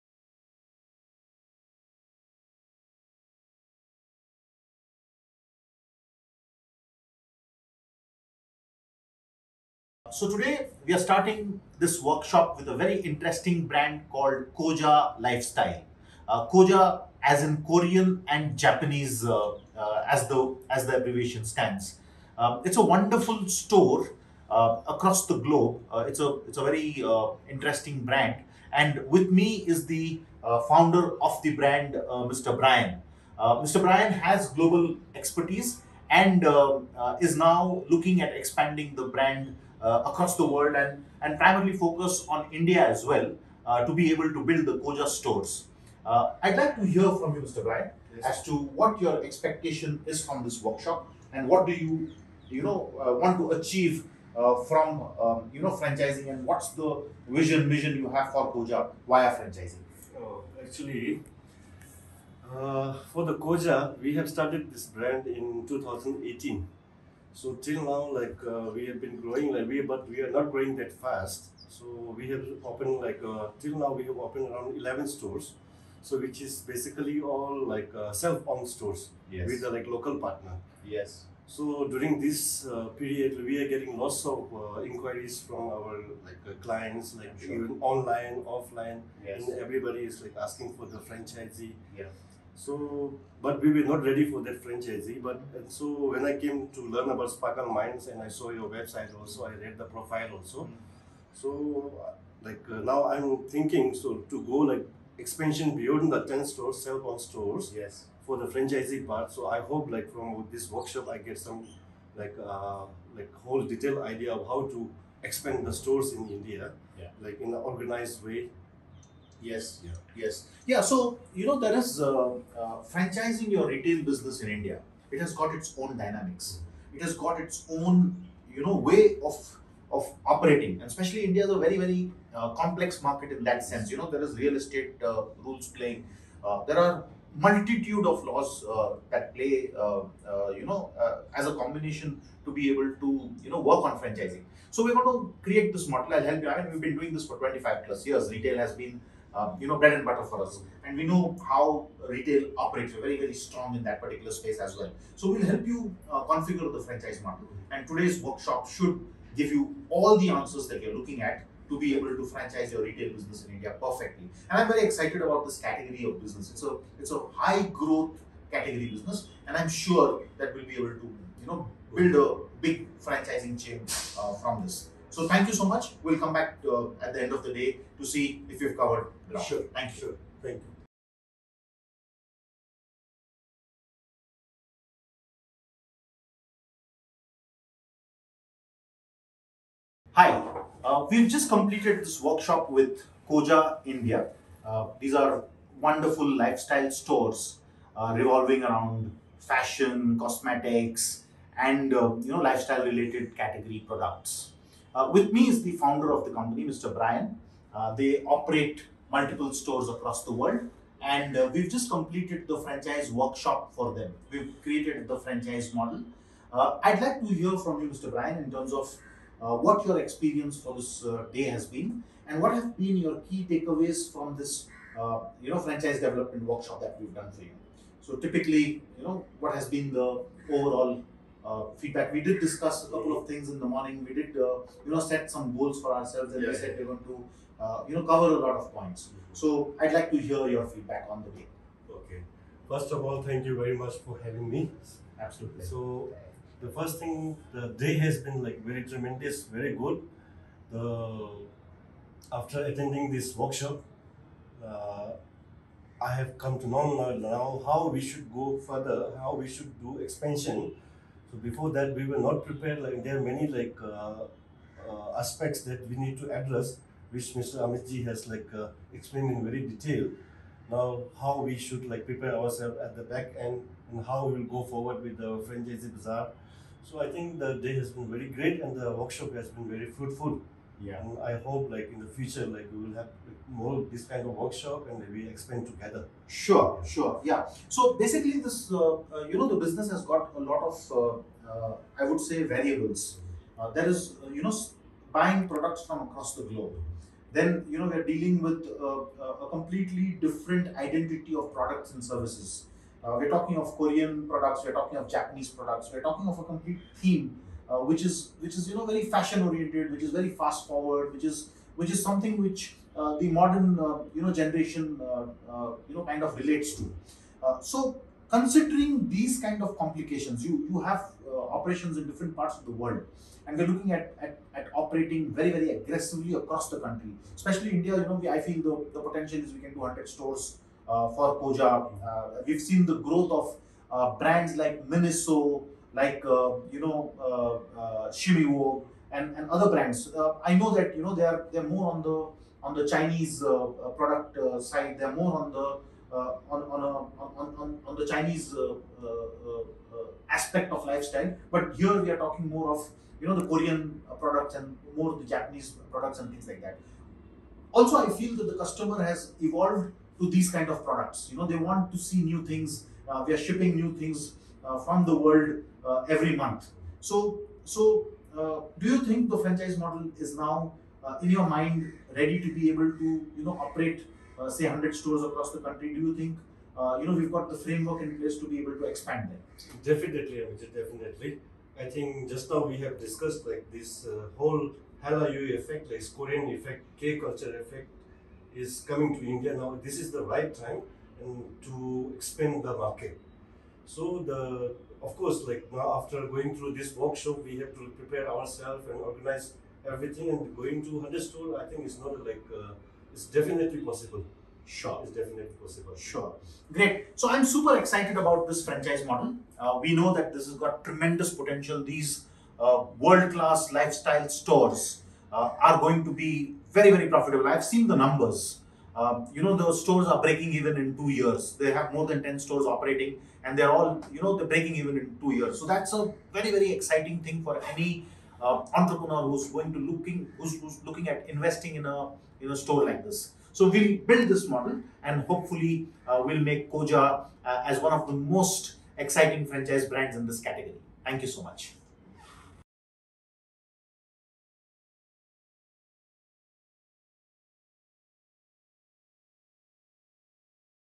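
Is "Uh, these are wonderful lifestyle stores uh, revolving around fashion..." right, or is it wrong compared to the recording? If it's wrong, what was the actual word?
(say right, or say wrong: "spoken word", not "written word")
right.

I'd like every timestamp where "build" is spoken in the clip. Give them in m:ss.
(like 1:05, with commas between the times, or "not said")
0:44, 2:51, 7:13.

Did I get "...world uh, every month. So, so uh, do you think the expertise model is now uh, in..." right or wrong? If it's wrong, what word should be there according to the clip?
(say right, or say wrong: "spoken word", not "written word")
wrong: "franchise", not "expertise".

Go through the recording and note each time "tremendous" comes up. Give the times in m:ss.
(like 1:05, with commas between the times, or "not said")
4:08, 6:50.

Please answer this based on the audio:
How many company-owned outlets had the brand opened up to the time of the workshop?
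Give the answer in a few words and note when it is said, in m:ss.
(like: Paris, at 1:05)
11, at 1:14.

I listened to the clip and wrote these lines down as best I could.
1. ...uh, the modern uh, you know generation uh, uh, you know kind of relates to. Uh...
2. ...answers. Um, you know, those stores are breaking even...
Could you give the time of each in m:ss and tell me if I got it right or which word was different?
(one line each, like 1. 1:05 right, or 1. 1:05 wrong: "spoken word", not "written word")
1. 5:12 right
2. 6:57 wrong: "numbers", not "answers".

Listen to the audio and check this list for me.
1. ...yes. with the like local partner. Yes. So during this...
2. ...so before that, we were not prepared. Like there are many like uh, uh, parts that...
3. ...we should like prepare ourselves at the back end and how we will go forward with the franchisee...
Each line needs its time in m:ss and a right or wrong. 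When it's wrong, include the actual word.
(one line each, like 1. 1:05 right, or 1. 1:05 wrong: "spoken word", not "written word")
1. 1:19 right
2. 4:21 wrong: "aspects", not "parts"
3. 4:31 right.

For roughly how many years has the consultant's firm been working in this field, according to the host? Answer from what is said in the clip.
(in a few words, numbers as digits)
25.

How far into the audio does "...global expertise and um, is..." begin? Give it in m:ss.
0:34.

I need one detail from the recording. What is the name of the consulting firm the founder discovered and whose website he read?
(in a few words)
Sparkleminds.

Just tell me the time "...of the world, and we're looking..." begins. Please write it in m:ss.
5:22.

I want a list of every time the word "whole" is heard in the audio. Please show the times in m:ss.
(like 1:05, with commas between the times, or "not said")
1:53, 6:24.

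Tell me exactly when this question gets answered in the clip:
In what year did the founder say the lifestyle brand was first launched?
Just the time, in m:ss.
1:05.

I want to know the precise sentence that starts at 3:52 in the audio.
We did discuss a couple of things in the morning.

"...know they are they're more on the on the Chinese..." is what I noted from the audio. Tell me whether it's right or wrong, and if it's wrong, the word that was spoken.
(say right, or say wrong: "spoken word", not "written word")
right.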